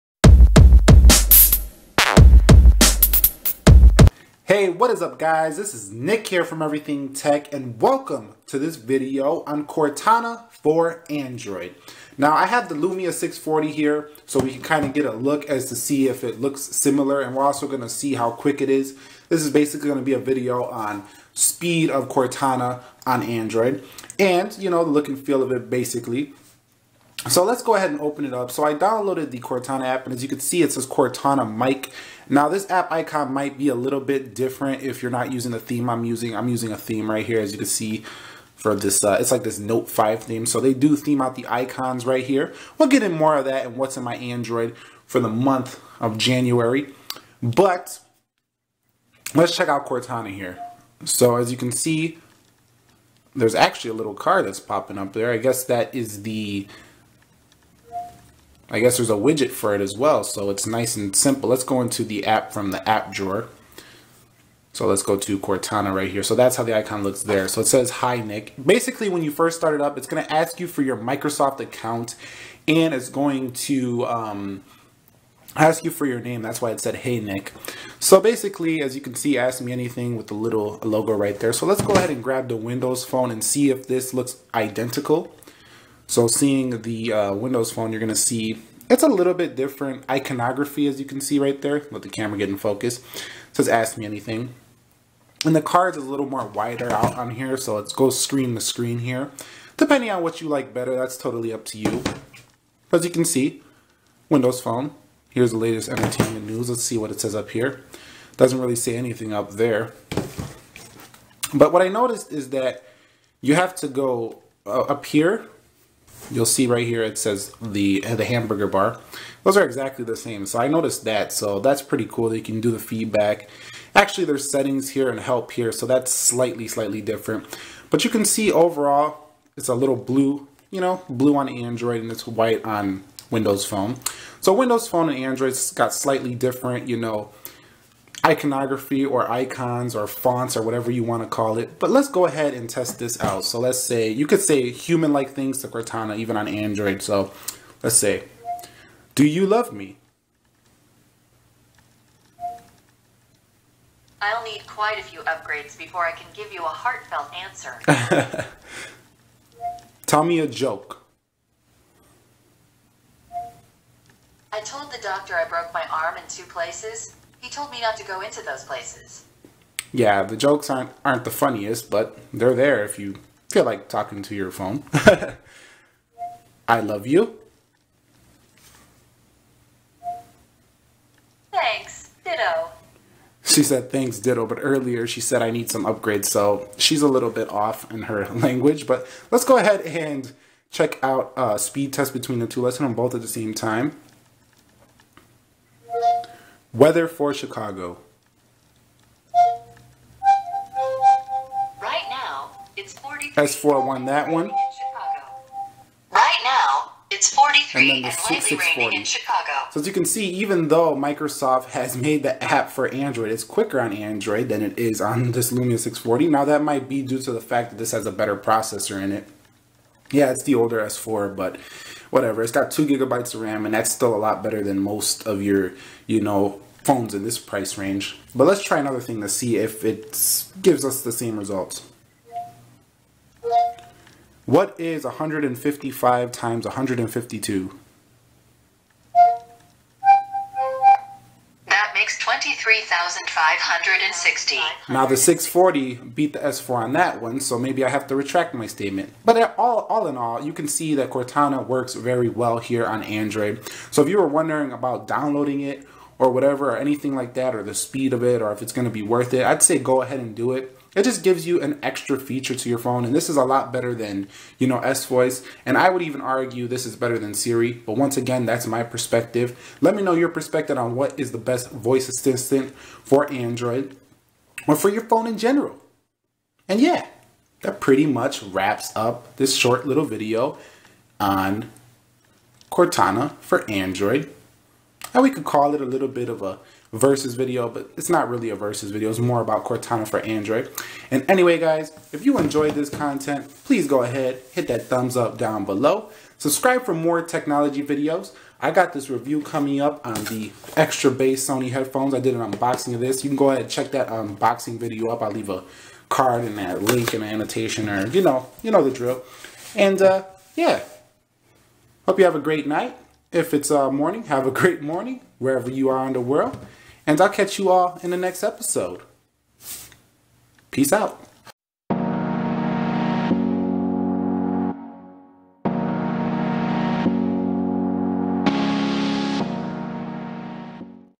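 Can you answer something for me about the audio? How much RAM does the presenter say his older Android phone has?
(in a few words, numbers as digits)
2 gigabytes.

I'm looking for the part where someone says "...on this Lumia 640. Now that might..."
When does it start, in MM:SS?
03:35.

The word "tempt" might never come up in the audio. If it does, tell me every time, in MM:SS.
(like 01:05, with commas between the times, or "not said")
not said.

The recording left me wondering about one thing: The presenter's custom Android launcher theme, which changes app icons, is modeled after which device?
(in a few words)
Note 5.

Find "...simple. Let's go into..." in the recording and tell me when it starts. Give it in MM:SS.
01:01.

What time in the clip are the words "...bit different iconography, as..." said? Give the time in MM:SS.
01:29.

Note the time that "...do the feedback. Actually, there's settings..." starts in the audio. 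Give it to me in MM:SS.
02:02.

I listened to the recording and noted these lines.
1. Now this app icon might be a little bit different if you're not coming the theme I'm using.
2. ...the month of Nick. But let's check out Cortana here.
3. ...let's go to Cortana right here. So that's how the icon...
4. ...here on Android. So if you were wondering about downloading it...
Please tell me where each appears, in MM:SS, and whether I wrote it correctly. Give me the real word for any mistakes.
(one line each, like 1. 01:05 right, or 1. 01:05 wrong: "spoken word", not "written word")
1. 00:32 wrong: "using", not "coming"
2. 00:45 wrong: "January", not "Nick"
3. 01:04 right
4. 04:12 right.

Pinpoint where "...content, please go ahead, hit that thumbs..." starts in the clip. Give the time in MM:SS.
04:52.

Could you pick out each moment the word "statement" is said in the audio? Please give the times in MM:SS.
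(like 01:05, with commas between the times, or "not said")
04:08.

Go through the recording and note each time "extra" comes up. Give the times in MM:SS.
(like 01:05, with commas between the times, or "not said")
04:21, 05:00.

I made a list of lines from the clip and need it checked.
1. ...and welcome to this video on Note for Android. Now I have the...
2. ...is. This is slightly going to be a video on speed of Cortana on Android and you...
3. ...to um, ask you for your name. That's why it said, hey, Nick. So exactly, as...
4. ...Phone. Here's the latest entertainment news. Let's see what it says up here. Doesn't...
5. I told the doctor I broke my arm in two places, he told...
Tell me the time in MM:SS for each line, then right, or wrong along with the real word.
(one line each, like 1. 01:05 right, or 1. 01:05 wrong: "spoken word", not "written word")
1. 00:07 wrong: "Cortana", not "Note"
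2. 00:18 wrong: "basically", not "slightly"
3. 01:13 wrong: "basically", not "exactly"
4. 01:44 right
5. 02:44 right.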